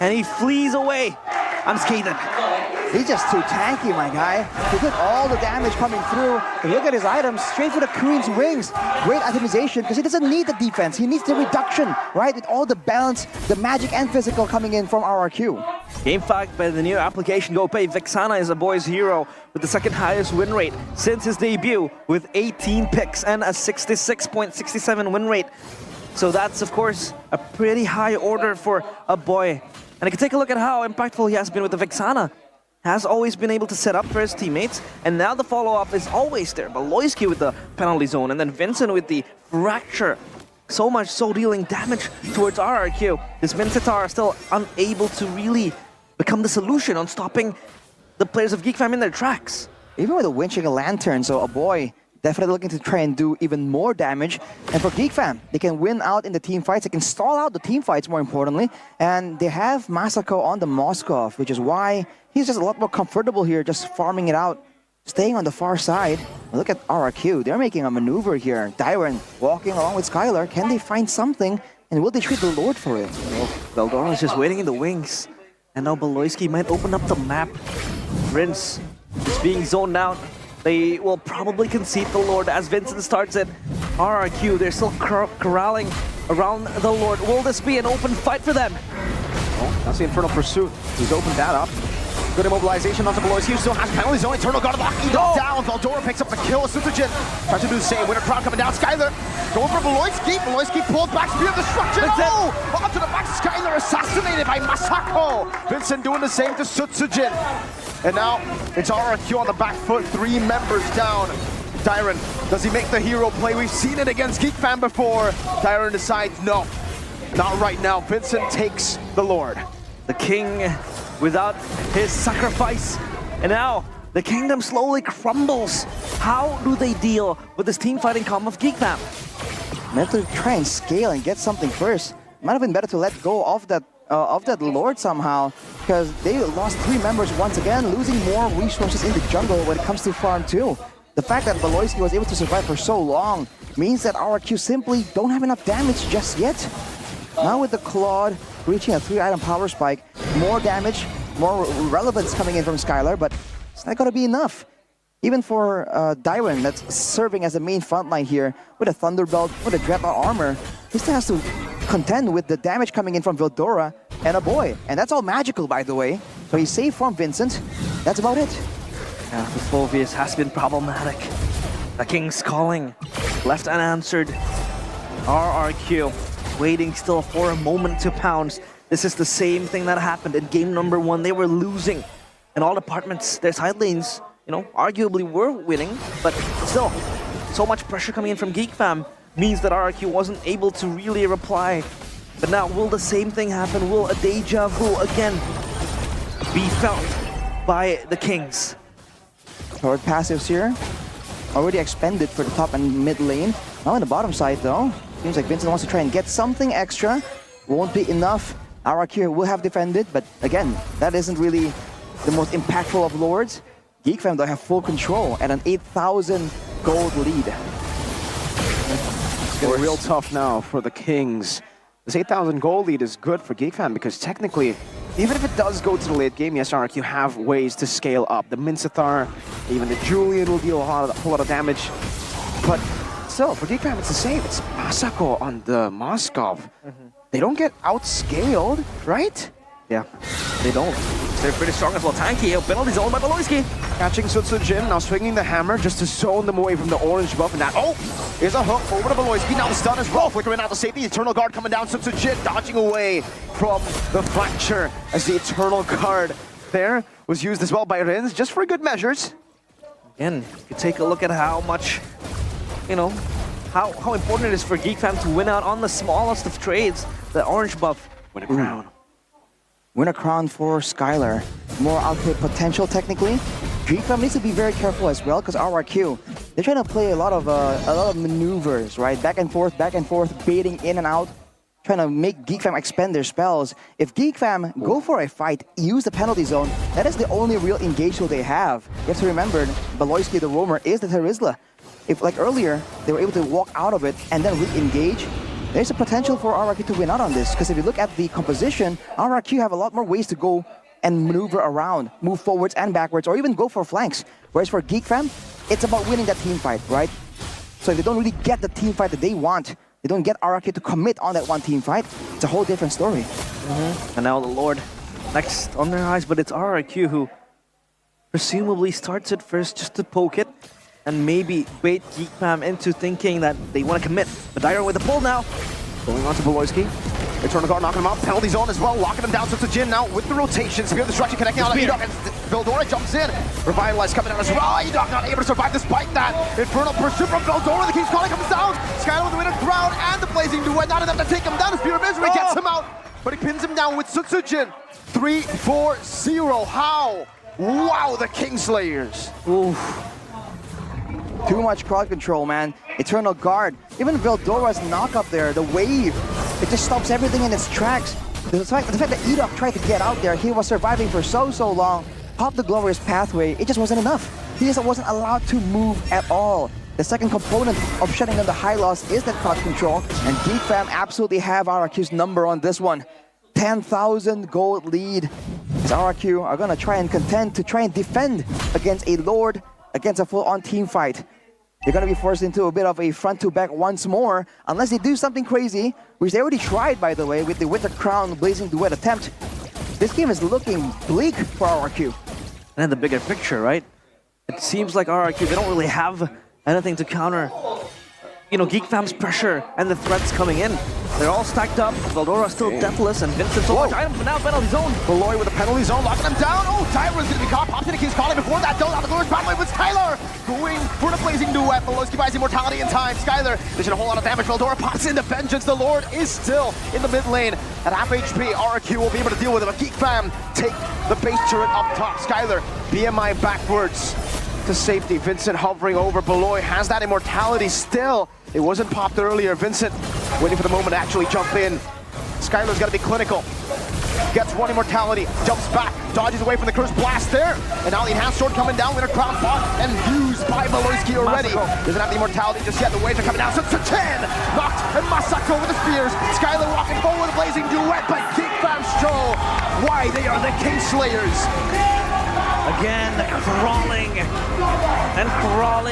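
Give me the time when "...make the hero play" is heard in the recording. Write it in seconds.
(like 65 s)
112 s.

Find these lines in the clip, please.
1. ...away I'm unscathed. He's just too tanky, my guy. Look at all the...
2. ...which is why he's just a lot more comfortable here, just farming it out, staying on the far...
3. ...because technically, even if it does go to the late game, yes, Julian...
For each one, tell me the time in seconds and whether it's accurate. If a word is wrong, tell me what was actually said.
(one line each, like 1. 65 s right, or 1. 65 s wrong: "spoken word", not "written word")
1. 0 s right
2. 61 s right
3. 223 s wrong: "Ark", not "Julian".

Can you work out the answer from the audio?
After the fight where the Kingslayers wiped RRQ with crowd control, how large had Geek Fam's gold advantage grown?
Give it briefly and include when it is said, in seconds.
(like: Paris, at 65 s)
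10,000 gold, at 373 s.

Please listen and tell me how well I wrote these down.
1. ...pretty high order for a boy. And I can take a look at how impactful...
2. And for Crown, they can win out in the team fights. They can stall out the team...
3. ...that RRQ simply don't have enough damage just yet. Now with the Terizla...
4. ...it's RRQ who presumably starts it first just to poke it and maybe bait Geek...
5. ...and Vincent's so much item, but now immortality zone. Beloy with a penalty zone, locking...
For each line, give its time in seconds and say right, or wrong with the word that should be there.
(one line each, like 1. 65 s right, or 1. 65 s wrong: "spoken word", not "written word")
1. 27 s right
2. 54 s wrong: "GeekFam", not "Crown"
3. 144 s wrong: "Claude", not "Terizla"
4. 316 s right
5. 403 s wrong: "penalty", not "immortality".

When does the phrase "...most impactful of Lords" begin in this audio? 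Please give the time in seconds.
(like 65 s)
212 s.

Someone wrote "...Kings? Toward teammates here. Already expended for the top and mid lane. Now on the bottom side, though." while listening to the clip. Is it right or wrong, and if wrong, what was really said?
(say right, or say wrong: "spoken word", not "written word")
wrong: "passives", not "teammates".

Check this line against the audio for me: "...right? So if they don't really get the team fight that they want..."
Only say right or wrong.
right.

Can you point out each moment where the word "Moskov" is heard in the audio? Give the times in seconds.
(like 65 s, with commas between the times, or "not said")
60 s, 235 s.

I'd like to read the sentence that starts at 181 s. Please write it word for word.
They were losing in all departments.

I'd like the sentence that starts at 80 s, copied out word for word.
They will probably concede the Lord as Vincent starts it.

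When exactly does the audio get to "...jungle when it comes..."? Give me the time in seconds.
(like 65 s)
139 s.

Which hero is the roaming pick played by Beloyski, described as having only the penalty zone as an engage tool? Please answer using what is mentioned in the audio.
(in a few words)
Terizla.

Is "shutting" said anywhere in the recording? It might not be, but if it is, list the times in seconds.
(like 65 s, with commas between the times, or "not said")
368 s.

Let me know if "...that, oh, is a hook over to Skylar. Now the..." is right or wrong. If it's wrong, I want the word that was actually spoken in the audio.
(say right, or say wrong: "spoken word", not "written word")
wrong: "Beloyski", not "Skylar".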